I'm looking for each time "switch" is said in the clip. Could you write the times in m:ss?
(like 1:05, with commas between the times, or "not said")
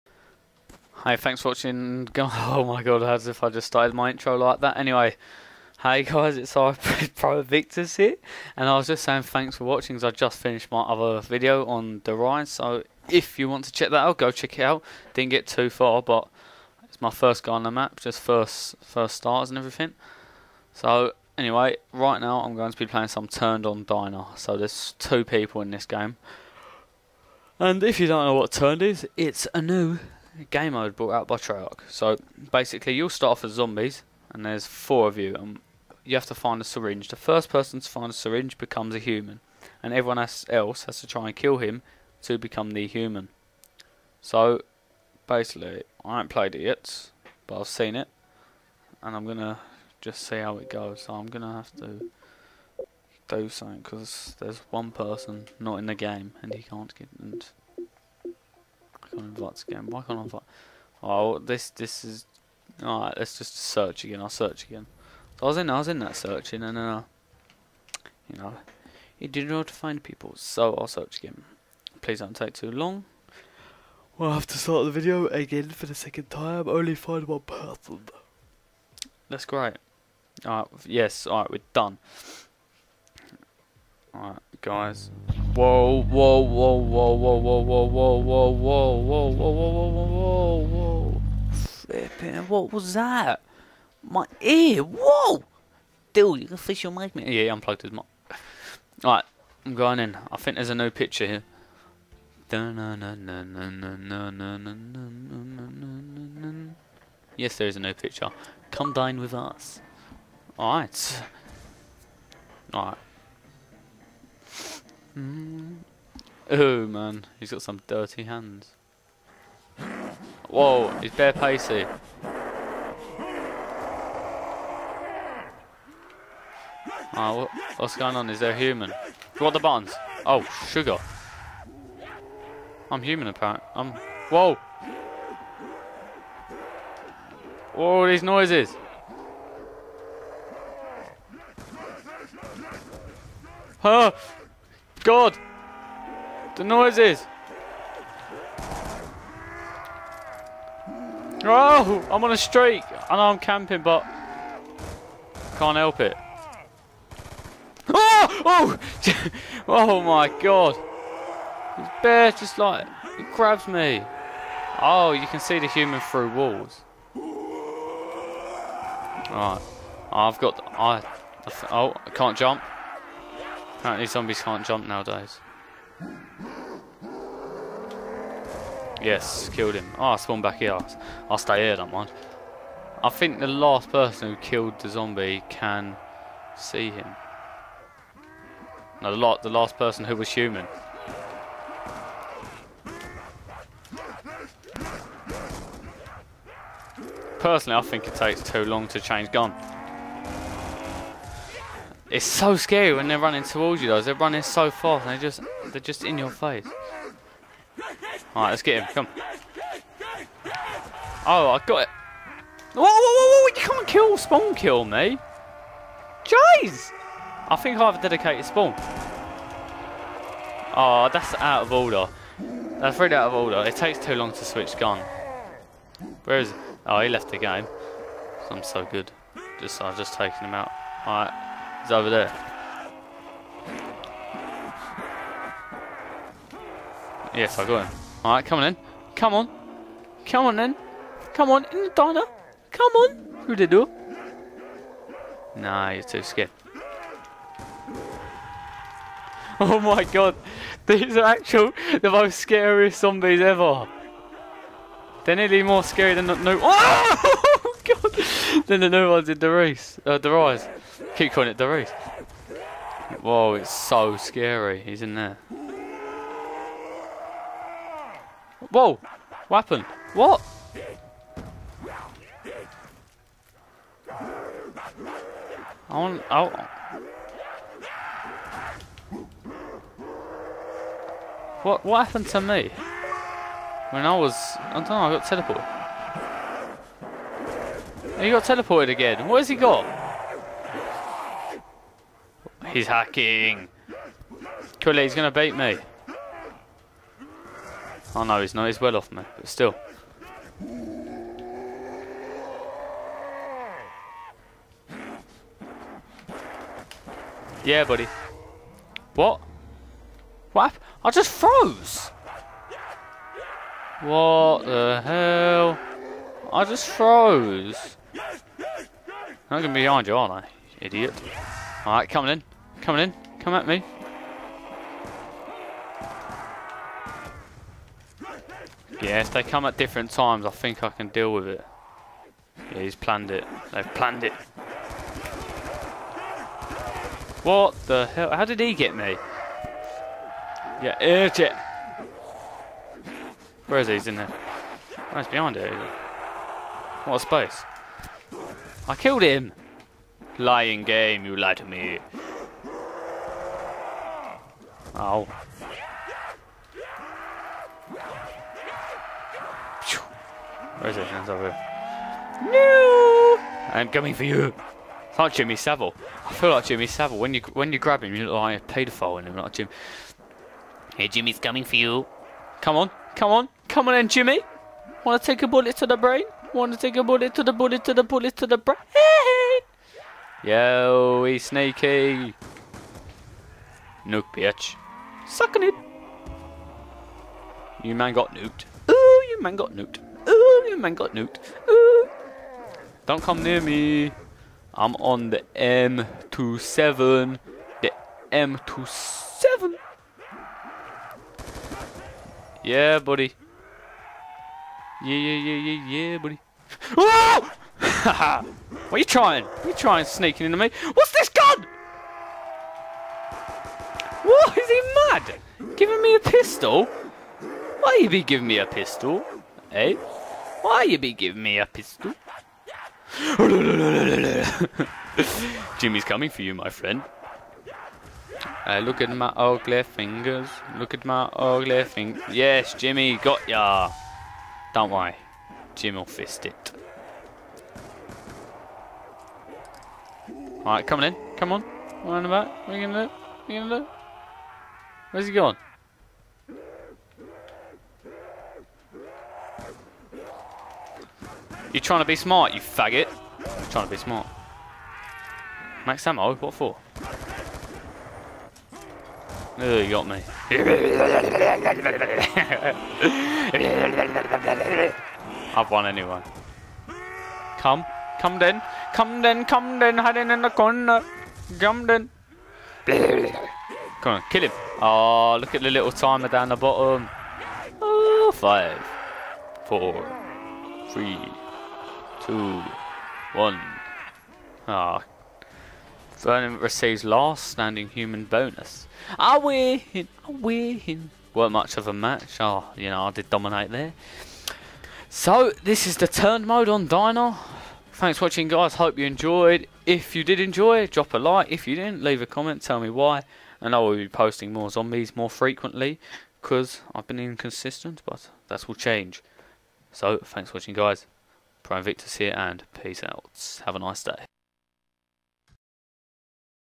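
3:44.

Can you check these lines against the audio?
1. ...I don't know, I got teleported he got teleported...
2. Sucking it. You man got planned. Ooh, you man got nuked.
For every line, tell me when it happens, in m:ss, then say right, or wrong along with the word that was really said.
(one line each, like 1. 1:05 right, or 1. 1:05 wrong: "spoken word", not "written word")
1. 4:44 right
2. 6:25 wrong: "nuked", not "planned".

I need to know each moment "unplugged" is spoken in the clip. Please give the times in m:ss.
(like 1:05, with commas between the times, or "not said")
1:37.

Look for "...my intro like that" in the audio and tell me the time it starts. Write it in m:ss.
0:03.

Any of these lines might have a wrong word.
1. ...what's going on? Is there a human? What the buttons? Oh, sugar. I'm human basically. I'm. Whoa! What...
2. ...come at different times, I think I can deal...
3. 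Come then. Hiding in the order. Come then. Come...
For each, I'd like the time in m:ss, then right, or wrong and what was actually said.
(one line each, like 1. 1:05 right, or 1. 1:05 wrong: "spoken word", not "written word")
1. 2:07 wrong: "apparently", not "basically"
2. 5:29 right
3. 7:49 wrong: "corner", not "order".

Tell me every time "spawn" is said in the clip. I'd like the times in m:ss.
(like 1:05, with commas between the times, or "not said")
3:00, 3:34, 3:38.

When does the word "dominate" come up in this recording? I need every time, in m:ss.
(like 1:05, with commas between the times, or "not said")
8:13.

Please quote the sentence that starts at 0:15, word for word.
Didn't get too far, but it's my first guy on the map, just first first stars and everything.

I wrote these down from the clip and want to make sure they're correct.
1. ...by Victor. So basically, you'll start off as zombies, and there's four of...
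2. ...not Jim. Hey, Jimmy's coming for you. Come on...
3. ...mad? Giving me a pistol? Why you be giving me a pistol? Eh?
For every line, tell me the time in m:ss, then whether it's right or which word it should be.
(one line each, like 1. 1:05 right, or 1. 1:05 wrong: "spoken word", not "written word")
1. 0:31 wrong: "Treyarch", not "Victor"
2. 6:09 right
3. 6:55 right.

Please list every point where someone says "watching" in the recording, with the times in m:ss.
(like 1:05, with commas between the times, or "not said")
0:01, 0:09, 8:18, 8:30.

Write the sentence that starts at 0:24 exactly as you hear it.
So there's two people in this game.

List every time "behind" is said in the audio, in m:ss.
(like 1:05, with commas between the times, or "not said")
5:19, 5:45.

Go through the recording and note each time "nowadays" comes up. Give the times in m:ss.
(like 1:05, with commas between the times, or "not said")
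2:54.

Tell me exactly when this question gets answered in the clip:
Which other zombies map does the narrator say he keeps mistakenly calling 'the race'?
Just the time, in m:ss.
4:20.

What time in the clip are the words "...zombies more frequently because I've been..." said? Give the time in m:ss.
8:24.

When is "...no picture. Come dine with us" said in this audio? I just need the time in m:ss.
1:47.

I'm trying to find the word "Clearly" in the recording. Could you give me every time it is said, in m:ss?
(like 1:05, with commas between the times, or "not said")
4:54.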